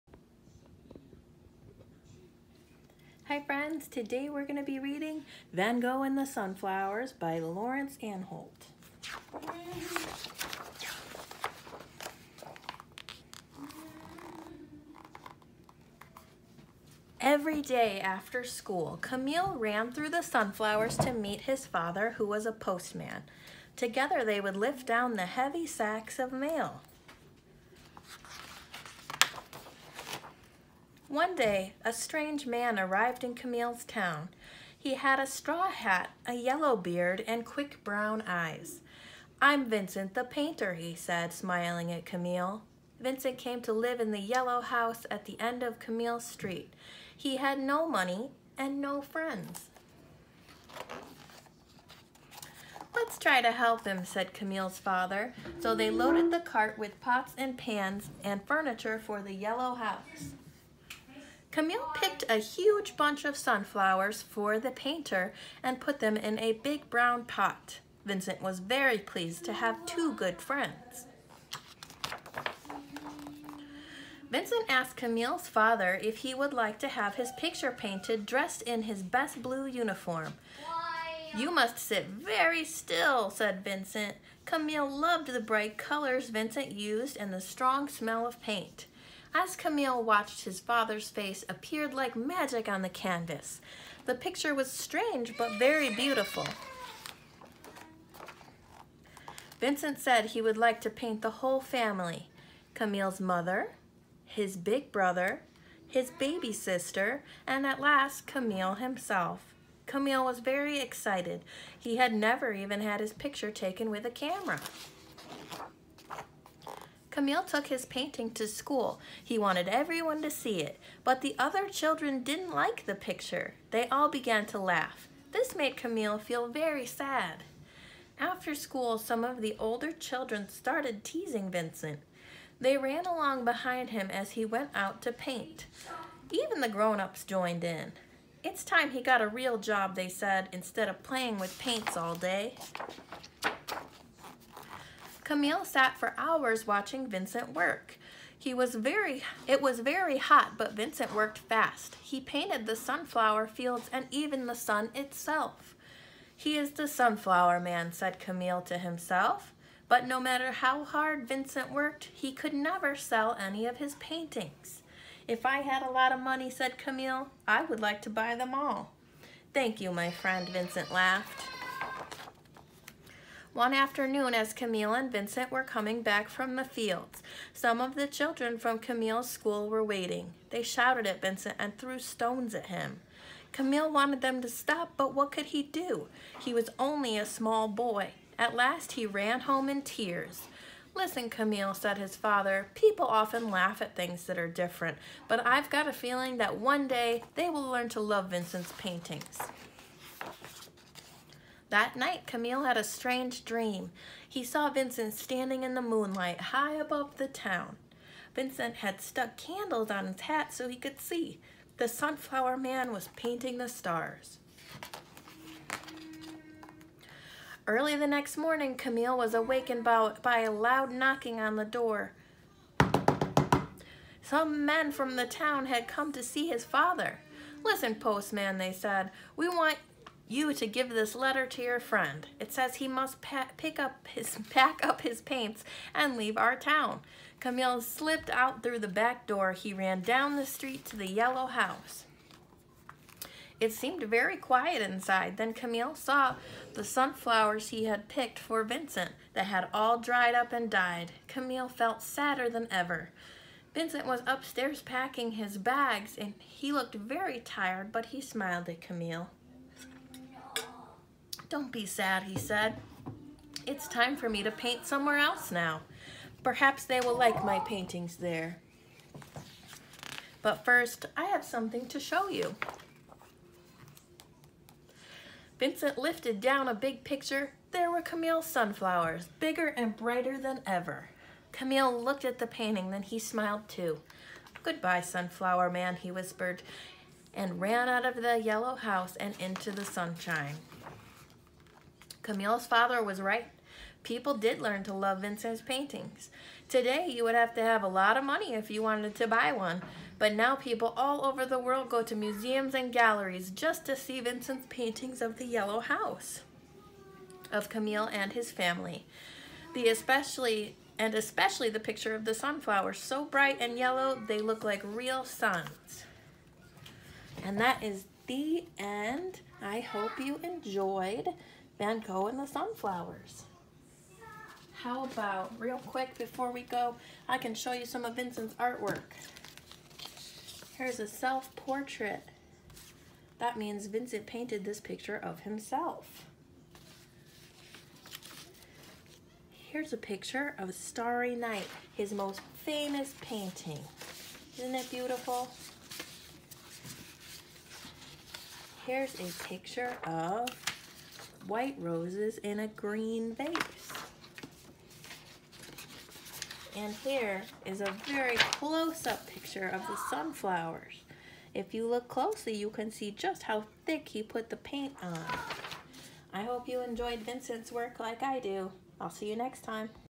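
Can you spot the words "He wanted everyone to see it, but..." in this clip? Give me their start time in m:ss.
1:59.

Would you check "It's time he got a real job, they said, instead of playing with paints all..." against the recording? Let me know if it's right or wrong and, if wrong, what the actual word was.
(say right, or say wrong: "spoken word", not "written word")
right.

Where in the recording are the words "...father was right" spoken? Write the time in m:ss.
4:52.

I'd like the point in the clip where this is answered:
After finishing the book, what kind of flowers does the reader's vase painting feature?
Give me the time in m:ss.
5:51.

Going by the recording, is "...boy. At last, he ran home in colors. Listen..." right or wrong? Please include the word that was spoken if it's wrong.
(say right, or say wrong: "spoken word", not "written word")
wrong: "tears", not "colors".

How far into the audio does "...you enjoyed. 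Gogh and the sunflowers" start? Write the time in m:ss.
5:20.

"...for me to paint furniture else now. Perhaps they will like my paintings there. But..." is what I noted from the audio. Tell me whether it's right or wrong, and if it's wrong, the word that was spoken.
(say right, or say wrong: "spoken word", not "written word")
wrong: "somewhere", not "furniture".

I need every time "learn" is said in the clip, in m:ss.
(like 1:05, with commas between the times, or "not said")
3:17, 4:54.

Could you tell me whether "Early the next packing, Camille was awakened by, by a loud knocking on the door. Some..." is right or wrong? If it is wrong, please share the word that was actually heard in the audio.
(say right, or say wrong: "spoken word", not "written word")
wrong: "morning", not "packing".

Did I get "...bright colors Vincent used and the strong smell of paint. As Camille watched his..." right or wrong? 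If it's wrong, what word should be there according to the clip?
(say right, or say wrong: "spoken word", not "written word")
right.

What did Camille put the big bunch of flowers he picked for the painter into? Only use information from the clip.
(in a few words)
A big brown pot.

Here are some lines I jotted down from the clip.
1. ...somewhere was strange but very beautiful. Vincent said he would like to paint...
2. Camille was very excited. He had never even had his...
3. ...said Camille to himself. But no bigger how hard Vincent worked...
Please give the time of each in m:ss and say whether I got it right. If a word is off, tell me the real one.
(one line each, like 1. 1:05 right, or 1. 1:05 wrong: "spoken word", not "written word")
1. 1:34 wrong: "picture", not "somewhere"
2. 1:49 right
3. 2:37 wrong: "matter", not "bigger".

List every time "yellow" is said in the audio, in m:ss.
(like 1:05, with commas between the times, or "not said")
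0:36, 0:44, 0:59, 4:01, 4:48, 5:05, 5:13.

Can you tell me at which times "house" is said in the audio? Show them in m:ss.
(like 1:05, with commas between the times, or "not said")
0:44, 0:59, 4:01, 4:48, 5:05.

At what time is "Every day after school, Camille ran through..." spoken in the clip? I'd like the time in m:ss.
0:17.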